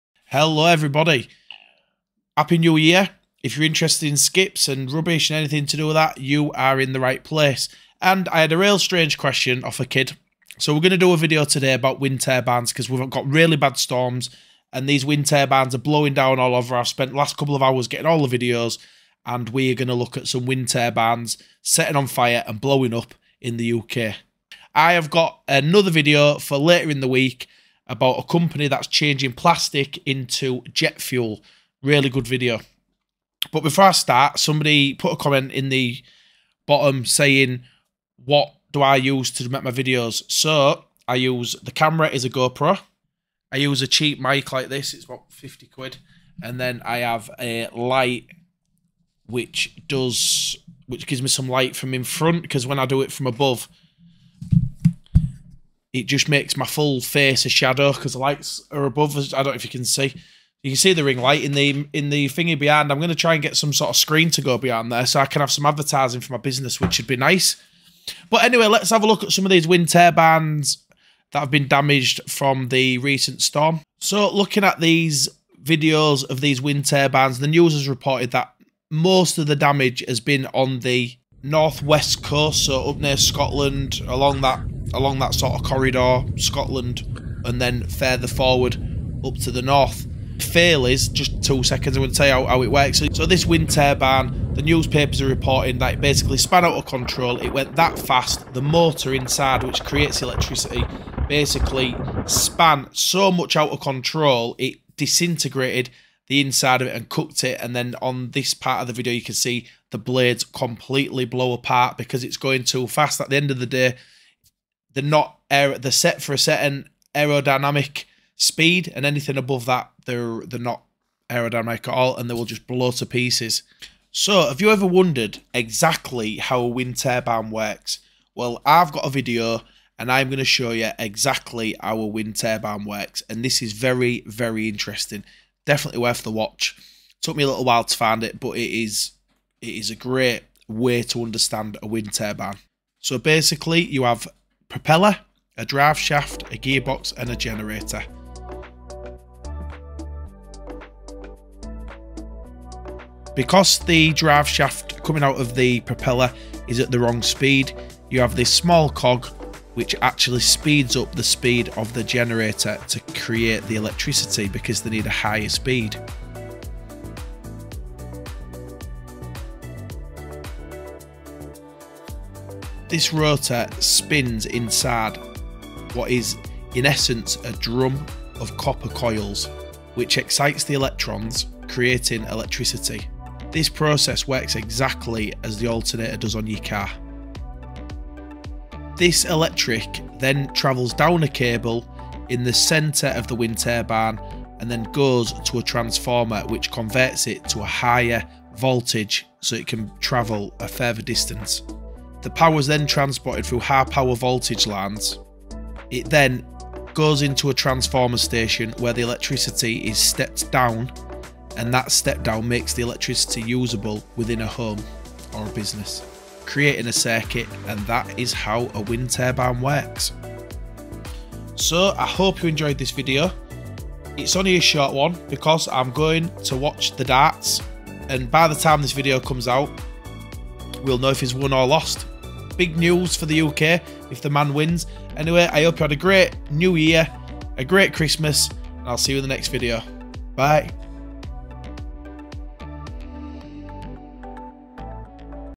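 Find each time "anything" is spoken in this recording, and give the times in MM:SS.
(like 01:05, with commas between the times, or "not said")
00:05, 01:59.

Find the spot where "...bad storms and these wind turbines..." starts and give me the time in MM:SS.
00:13.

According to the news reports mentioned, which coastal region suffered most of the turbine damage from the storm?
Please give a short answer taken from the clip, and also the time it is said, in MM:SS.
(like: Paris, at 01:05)
northwest coast, at 01:21.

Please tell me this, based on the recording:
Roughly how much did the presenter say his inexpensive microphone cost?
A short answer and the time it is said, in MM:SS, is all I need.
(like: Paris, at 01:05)
50 quid, at 00:45.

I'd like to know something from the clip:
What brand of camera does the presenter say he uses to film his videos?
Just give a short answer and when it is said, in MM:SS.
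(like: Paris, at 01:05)
GoPro, at 00:42.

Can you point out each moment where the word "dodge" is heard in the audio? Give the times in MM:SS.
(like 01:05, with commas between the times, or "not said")
not said.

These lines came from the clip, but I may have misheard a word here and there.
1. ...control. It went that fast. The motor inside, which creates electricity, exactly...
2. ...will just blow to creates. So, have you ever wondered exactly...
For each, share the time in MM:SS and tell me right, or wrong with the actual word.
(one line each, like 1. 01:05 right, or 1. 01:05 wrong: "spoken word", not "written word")
1. 01:36 wrong: "basically", not "exactly"
2. 02:02 wrong: "pieces", not "creates".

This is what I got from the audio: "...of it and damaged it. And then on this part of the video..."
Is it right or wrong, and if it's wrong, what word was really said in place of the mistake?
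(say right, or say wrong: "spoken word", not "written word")
wrong: "cooked", not "damaged".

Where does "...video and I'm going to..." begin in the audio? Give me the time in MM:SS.
02:09.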